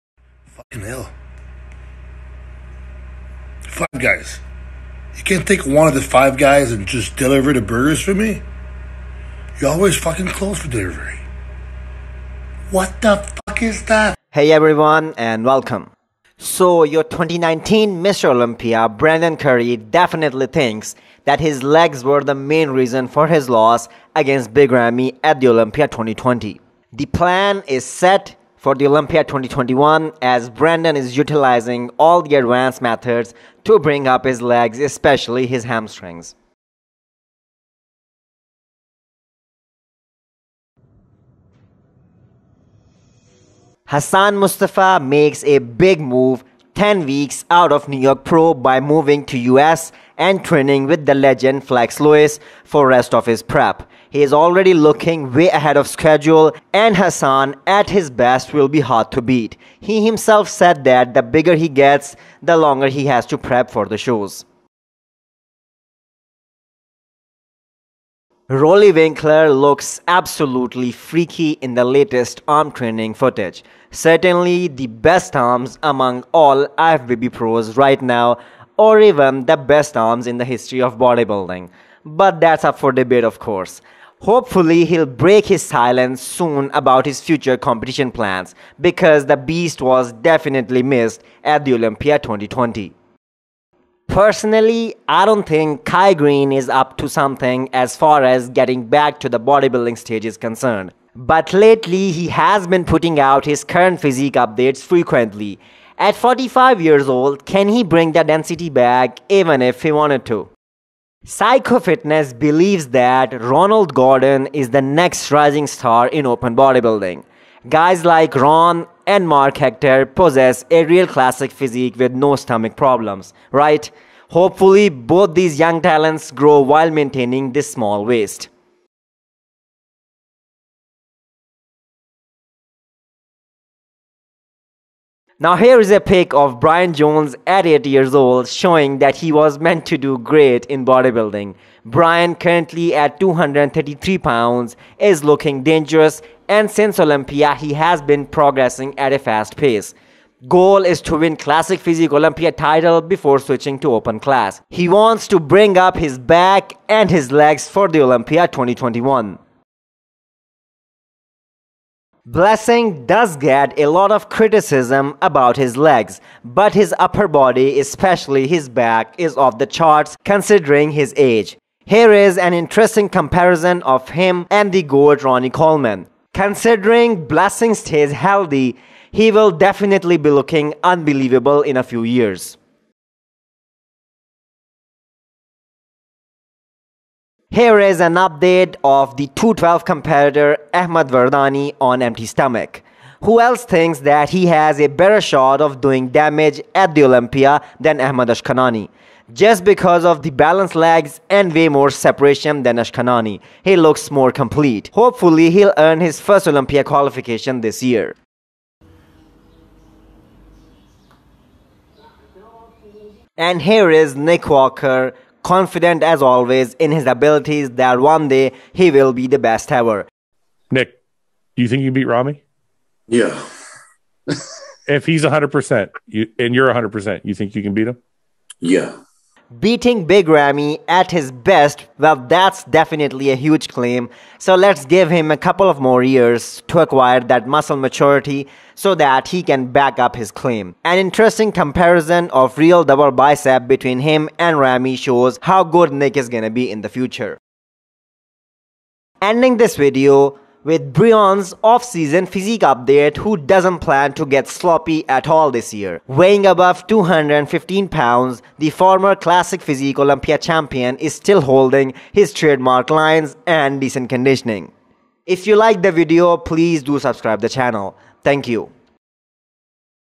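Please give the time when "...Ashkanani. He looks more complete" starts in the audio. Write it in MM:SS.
03:22.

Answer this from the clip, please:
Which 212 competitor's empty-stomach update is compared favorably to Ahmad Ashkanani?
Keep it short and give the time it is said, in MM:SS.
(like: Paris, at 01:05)
Ahmad Vardani, at 03:10.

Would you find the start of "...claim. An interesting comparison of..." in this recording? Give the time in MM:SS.
04:00.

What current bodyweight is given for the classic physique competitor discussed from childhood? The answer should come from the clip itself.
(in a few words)
233 pounds.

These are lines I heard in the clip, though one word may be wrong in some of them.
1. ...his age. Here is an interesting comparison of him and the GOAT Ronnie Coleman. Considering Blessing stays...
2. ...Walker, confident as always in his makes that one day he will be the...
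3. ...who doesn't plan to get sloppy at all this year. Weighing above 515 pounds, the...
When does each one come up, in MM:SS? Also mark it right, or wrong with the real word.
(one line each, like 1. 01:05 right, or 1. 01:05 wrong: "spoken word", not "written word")
1. 02:50 right
2. 03:34 wrong: "abilities", not "makes"
3. 04:13 wrong: "215", not "515".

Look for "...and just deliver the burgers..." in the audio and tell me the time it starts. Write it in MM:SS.
00:06.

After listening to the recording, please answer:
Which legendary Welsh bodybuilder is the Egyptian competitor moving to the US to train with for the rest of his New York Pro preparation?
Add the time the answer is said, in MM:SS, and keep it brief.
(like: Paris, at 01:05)
Flex Lewis, at 00:51.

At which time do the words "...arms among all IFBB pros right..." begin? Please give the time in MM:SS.
01:15.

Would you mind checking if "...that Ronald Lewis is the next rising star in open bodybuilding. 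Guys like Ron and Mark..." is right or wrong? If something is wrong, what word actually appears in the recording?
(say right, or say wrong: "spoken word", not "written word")
wrong: "Gordon", not "Lewis".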